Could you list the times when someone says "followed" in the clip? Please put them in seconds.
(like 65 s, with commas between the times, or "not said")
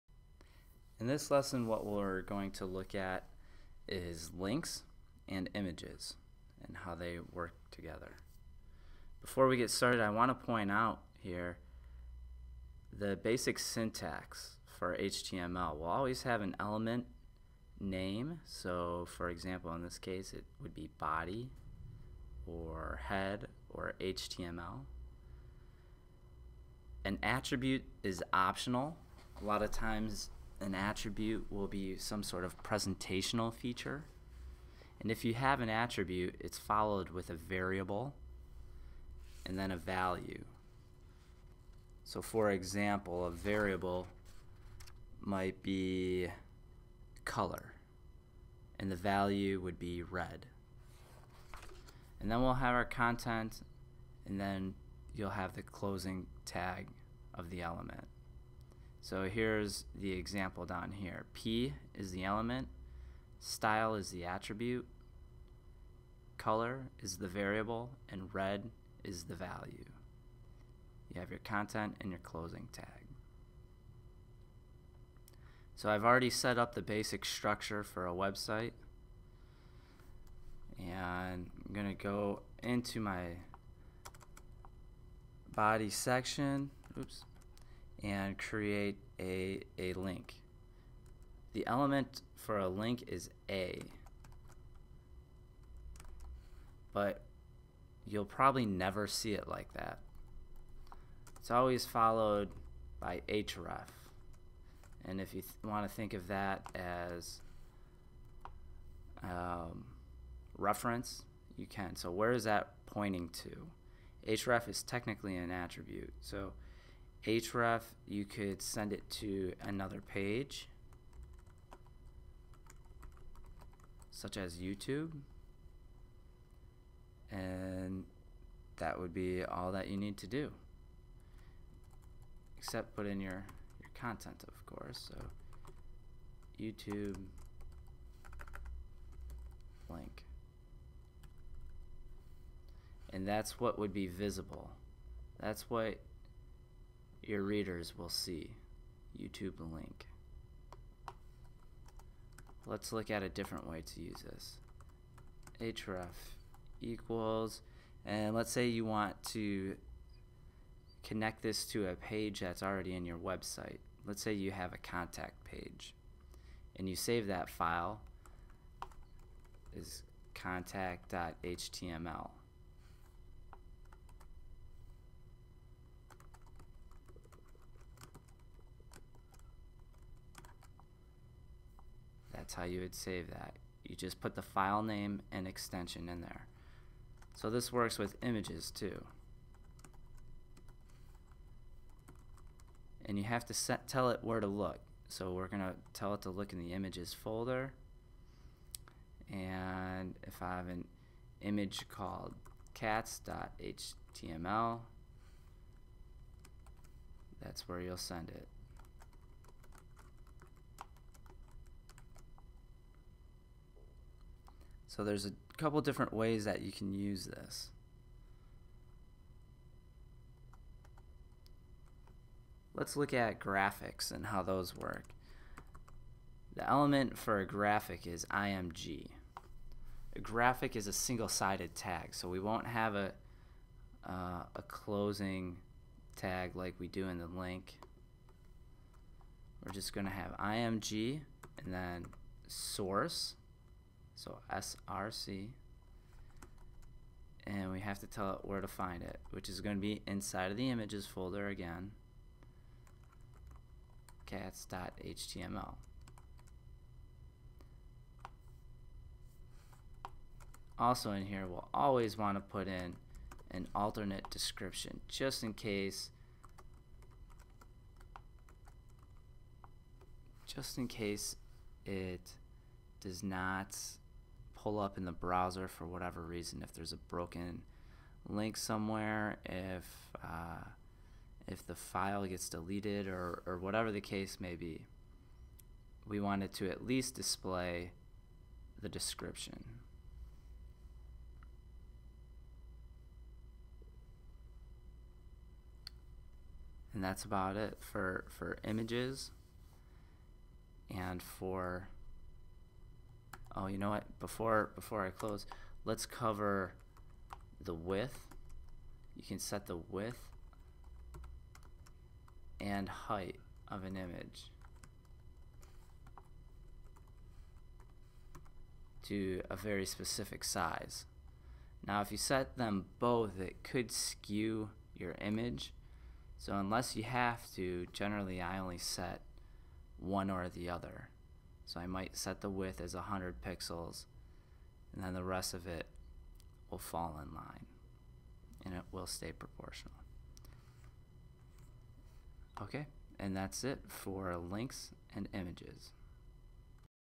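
36 s, 101 s.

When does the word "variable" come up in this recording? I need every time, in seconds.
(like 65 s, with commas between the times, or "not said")
37 s, 43 s, 67 s.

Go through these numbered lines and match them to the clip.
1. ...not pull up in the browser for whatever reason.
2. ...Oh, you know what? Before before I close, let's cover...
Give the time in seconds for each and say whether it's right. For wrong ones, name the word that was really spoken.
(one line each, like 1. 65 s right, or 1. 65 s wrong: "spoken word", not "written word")
1. 273 s right
2. 303 s right.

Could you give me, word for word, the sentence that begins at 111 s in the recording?
So where is that pointing to?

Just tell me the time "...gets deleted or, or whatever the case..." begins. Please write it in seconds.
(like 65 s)
282 s.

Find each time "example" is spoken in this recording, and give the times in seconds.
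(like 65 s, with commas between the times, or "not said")
19 s, 42 s, 60 s.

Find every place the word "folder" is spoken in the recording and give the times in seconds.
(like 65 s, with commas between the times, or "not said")
197 s, 251 s.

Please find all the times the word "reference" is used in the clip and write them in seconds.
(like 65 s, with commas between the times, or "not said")
110 s.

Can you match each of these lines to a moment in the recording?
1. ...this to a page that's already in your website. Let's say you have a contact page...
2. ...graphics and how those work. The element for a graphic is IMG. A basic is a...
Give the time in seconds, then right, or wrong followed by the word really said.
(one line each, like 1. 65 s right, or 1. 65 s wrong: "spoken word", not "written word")
1. 161 s right
2. 223 s wrong: "graphic", not "basic".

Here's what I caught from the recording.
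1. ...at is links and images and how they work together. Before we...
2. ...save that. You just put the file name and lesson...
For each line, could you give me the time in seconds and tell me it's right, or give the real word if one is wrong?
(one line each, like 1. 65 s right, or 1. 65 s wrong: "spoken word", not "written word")
1. 2 s right
2. 182 s wrong: "extension", not "lesson".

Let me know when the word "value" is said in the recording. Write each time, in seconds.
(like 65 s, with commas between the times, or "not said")
39 s, 48 s, 69 s.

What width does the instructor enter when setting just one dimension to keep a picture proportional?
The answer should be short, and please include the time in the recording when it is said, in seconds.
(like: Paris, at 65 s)
100 pixels, at 332 s.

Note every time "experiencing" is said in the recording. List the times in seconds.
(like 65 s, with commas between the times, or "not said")
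not said.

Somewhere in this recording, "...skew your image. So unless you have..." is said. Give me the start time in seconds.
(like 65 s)
323 s.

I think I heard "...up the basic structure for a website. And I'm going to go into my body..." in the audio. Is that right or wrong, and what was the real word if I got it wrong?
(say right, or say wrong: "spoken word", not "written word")
right.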